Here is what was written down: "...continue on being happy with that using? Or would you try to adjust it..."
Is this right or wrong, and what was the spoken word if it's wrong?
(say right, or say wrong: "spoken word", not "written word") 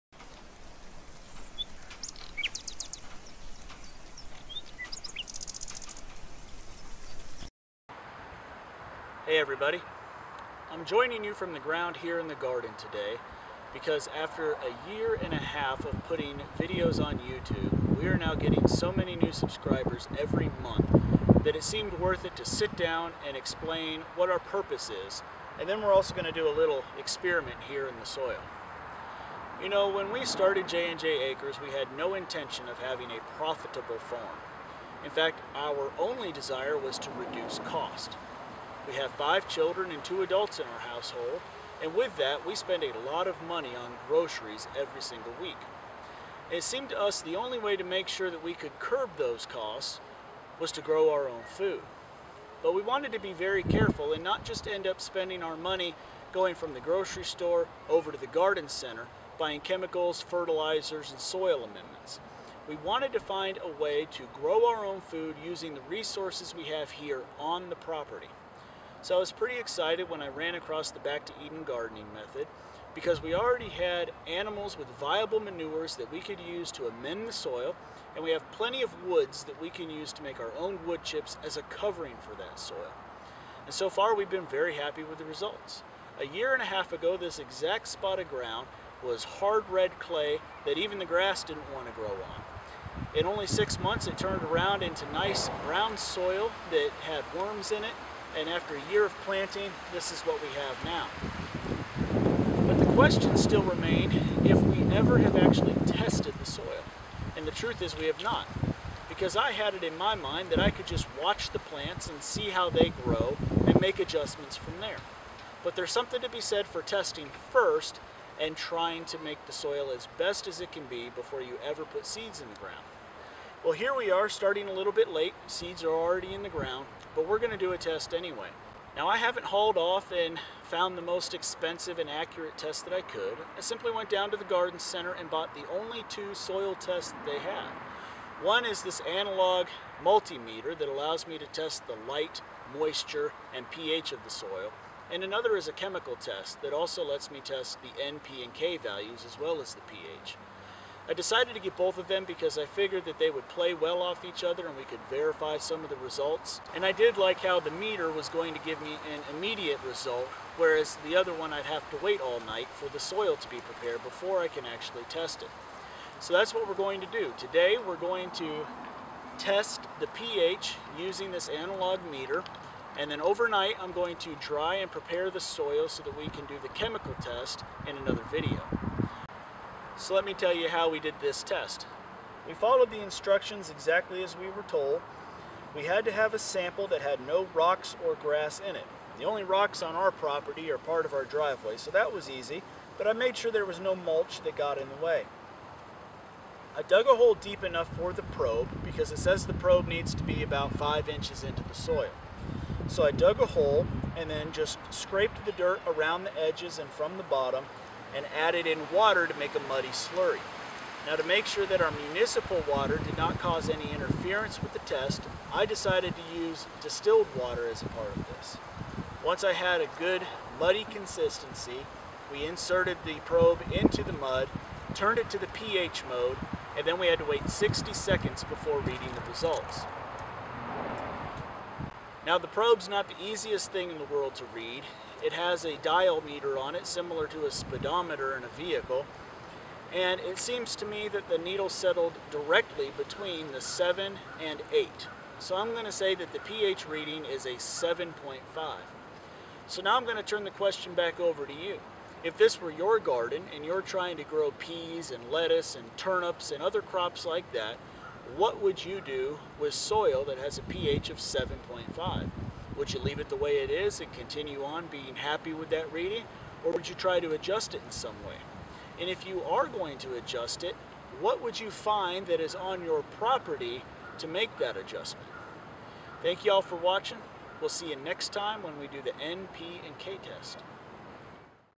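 wrong: "reading", not "using".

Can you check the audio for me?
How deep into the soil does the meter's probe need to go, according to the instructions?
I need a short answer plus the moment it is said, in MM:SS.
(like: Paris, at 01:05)
5 inches, at 03:20.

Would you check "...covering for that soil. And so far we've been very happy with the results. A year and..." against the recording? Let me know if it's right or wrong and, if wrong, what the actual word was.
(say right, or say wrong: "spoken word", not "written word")
right.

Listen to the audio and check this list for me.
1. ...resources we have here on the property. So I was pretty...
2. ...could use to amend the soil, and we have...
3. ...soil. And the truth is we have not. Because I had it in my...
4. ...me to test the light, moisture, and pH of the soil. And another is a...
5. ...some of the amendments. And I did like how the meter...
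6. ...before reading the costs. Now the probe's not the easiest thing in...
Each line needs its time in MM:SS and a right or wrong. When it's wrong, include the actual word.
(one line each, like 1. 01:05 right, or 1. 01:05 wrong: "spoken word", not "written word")
1. 01:05 right
2. 01:16 right
3. 01:46 right
4. 02:21 right
5. 02:35 wrong: "results", not "amendments"
6. 03:48 wrong: "results", not "costs".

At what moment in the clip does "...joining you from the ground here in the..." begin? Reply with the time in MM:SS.
00:10.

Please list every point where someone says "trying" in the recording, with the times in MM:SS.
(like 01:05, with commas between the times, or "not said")
01:58, 04:13.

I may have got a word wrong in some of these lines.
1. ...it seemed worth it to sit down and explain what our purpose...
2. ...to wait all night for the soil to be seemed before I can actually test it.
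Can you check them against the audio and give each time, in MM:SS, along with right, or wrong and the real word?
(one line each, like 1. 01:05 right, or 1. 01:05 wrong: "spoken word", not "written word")
1. 00:21 right
2. 02:41 wrong: "prepared", not "seemed".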